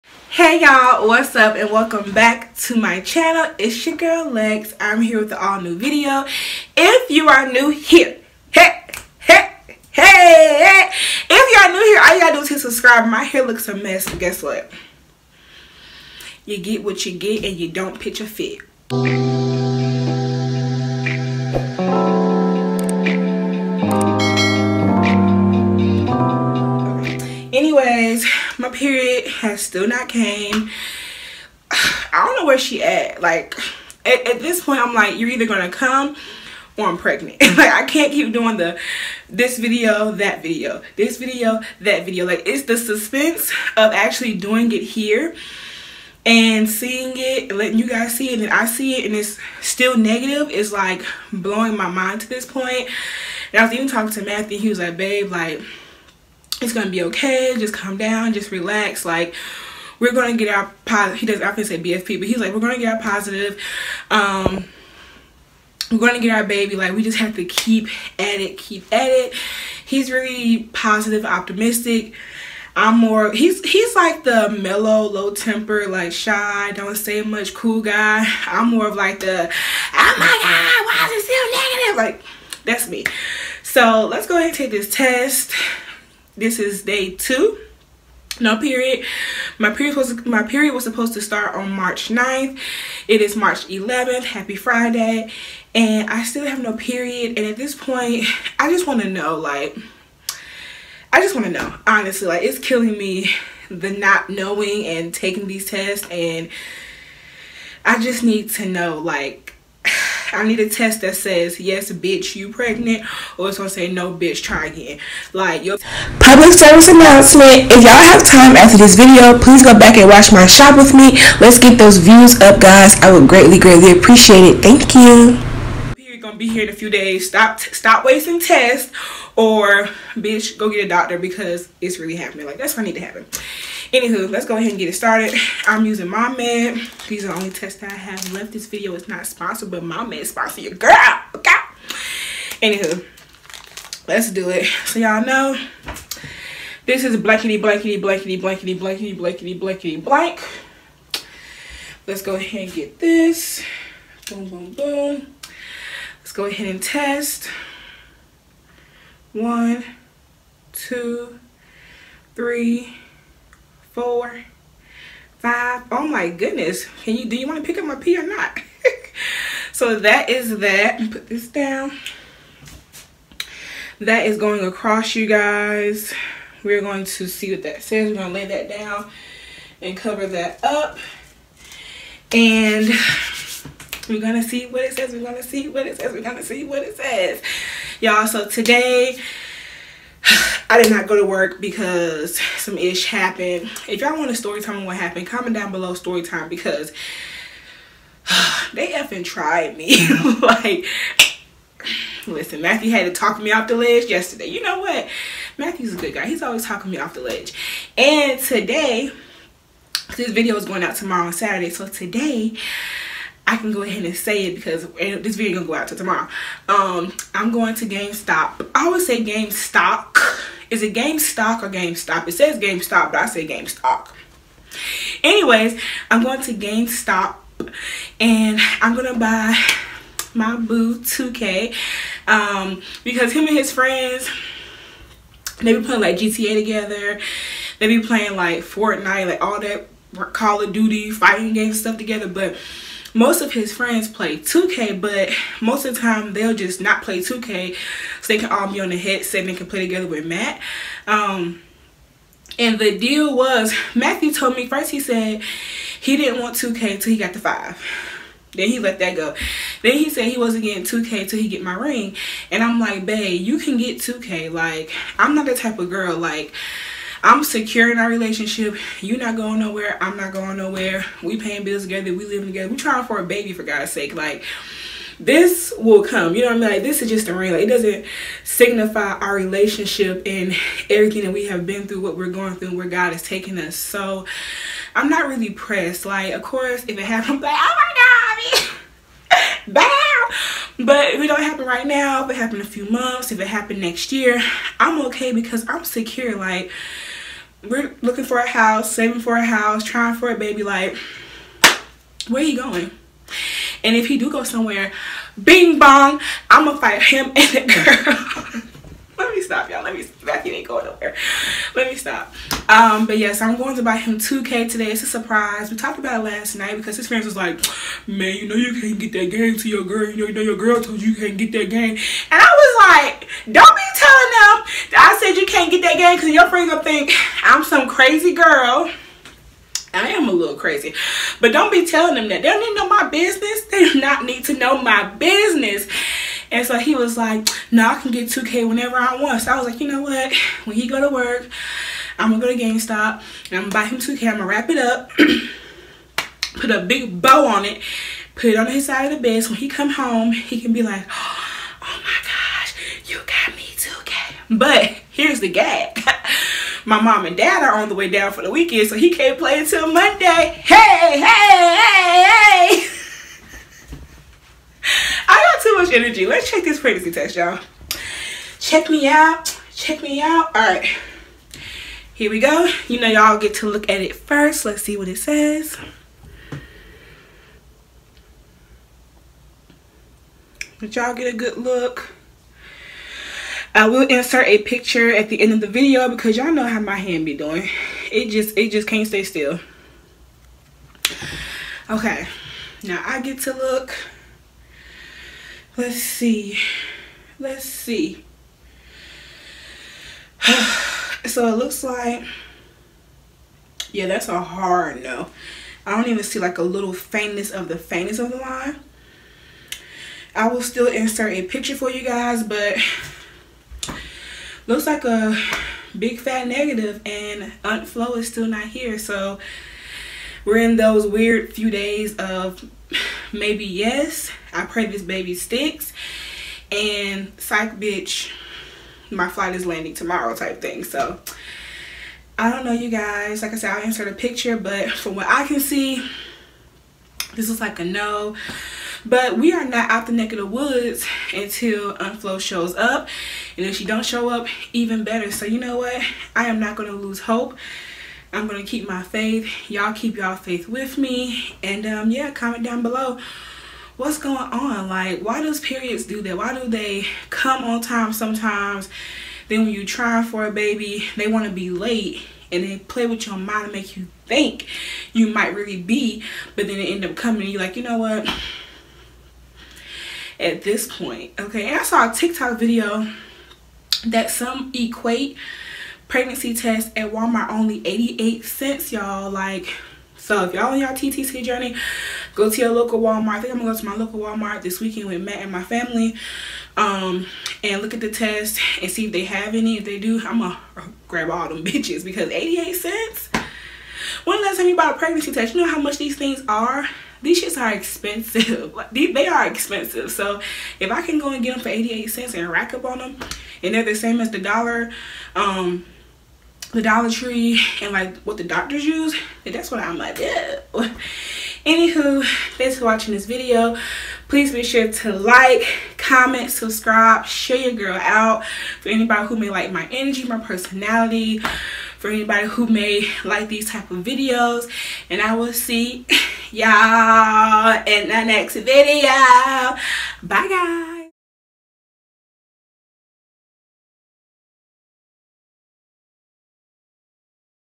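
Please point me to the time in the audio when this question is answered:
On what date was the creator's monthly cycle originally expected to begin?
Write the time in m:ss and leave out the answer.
1:31.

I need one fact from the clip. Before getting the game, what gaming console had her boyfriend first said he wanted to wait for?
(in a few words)
the 5.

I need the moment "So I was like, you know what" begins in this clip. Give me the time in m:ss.
5:39.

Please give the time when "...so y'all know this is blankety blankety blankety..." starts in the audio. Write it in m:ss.
2:24.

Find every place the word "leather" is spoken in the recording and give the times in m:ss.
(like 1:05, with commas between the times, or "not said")
not said.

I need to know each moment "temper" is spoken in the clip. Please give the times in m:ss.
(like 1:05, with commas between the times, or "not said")
1:15.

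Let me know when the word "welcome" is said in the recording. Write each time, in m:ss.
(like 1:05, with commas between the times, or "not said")
0:01.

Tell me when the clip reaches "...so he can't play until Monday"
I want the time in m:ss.
5:58.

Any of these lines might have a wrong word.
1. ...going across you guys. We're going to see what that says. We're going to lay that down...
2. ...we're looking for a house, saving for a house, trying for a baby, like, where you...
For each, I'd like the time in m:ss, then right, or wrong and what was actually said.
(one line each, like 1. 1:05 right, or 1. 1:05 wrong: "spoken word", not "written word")
1. 2:54 right
2. 4:57 right.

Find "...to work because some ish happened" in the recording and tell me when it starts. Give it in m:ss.
3:11.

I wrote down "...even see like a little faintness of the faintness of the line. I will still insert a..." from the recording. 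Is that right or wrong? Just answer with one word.
right.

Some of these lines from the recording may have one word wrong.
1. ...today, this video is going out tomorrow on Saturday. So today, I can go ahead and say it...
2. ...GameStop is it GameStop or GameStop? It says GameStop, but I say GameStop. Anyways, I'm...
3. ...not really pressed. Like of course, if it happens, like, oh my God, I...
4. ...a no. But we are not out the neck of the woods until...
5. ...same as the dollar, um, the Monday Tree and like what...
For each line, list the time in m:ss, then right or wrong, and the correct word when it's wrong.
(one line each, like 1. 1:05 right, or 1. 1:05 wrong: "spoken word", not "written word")
1. 3:28 right
2. 3:39 right
3. 4:45 right
4. 7:17 right
5. 8:23 wrong: "Dollar", not "Monday".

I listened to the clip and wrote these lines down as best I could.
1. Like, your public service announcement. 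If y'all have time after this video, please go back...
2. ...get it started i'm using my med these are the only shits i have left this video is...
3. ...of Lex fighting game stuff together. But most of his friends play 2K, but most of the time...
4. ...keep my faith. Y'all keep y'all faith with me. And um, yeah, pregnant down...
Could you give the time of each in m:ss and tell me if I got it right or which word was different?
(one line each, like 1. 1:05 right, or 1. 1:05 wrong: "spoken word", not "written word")
1. 1:55 right
2. 2:14 wrong: "tests", not "shits"
3. 4:00 wrong: "Duty", not "Lex"
4. 7:28 wrong: "comment", not "pregnant".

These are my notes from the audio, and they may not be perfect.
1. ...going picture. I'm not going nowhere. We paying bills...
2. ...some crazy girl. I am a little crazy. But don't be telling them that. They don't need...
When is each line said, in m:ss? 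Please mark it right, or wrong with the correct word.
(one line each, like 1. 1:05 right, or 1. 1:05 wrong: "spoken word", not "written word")
1. 4:29 wrong: "nowhere", not "picture"
2. 5:27 right.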